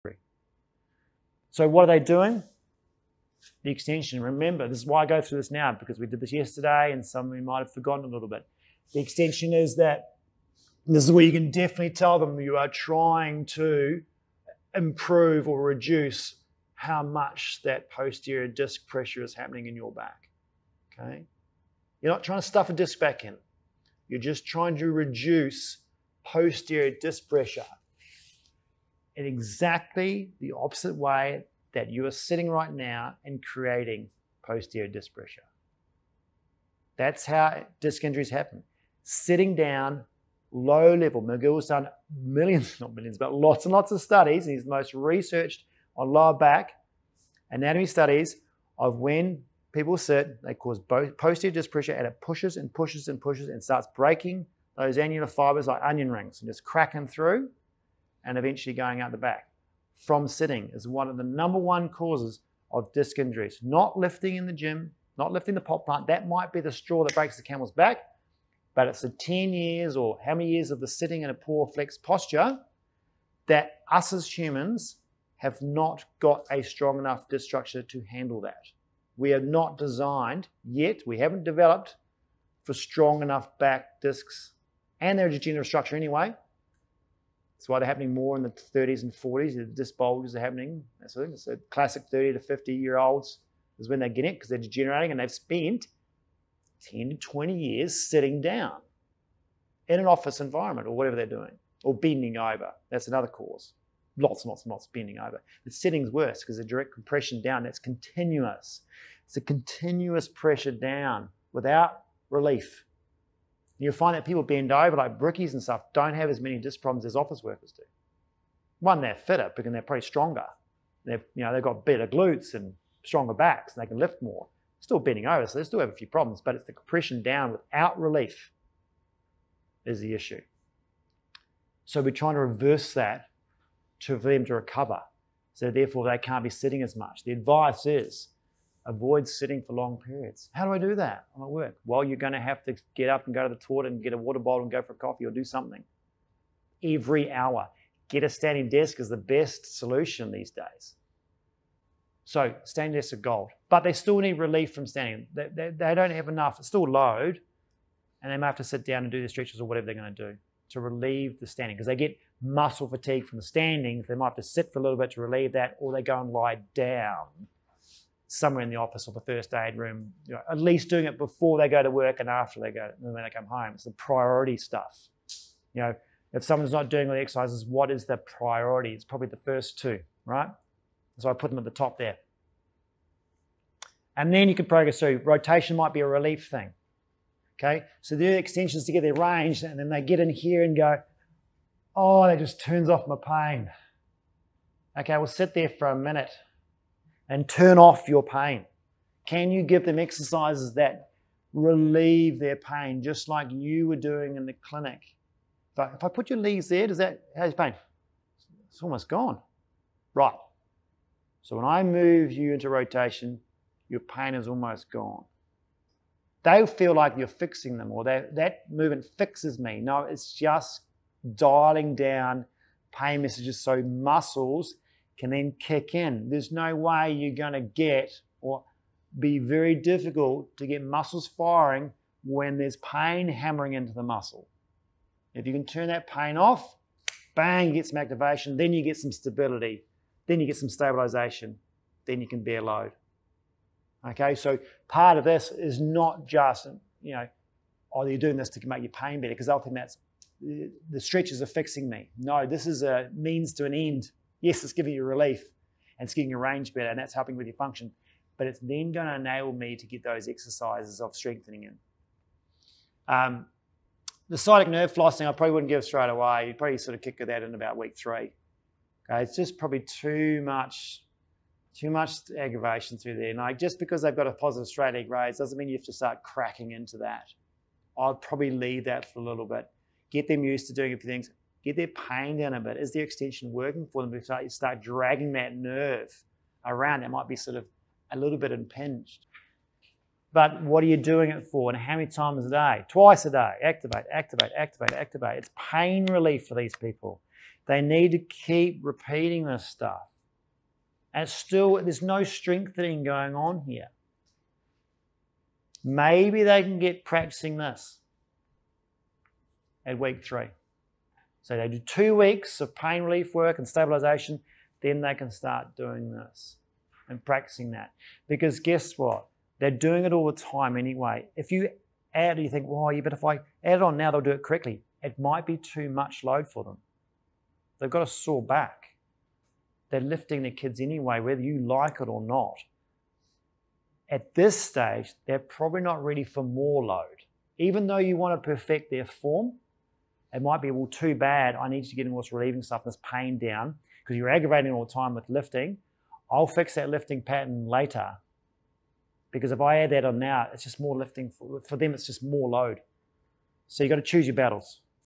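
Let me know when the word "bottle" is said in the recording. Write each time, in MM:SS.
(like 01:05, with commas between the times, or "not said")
02:24.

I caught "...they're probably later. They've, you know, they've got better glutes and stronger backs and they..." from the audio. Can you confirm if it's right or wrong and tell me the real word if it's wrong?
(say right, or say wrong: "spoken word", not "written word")
wrong: "stronger", not "later".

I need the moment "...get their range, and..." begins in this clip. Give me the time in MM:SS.
03:08.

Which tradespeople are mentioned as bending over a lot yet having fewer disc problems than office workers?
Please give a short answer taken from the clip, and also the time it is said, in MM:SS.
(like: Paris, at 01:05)
Brickies, at 01:55.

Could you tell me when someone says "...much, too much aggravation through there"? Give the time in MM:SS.
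04:30.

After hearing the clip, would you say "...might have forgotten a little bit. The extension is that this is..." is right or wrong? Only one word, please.
right.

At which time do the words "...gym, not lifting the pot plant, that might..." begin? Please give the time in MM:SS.
01:04.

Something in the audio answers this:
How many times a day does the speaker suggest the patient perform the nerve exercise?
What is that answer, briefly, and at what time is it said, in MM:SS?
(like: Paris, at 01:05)
Twice a day, at 04:52.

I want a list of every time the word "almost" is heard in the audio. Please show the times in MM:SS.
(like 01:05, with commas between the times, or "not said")
03:28, 03:34.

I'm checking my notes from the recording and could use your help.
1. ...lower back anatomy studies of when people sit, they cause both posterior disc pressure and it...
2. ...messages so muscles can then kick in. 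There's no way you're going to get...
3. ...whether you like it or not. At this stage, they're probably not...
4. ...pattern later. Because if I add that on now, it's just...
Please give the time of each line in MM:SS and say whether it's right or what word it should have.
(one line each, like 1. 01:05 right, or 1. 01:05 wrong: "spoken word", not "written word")
1. 00:46 right
2. 03:43 right
3. 05:31 right
4. 05:47 right.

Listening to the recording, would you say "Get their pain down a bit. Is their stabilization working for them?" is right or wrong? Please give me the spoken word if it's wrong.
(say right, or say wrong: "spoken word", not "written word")
wrong: "extension", not "stabilization".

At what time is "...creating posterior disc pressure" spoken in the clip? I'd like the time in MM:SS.
00:33.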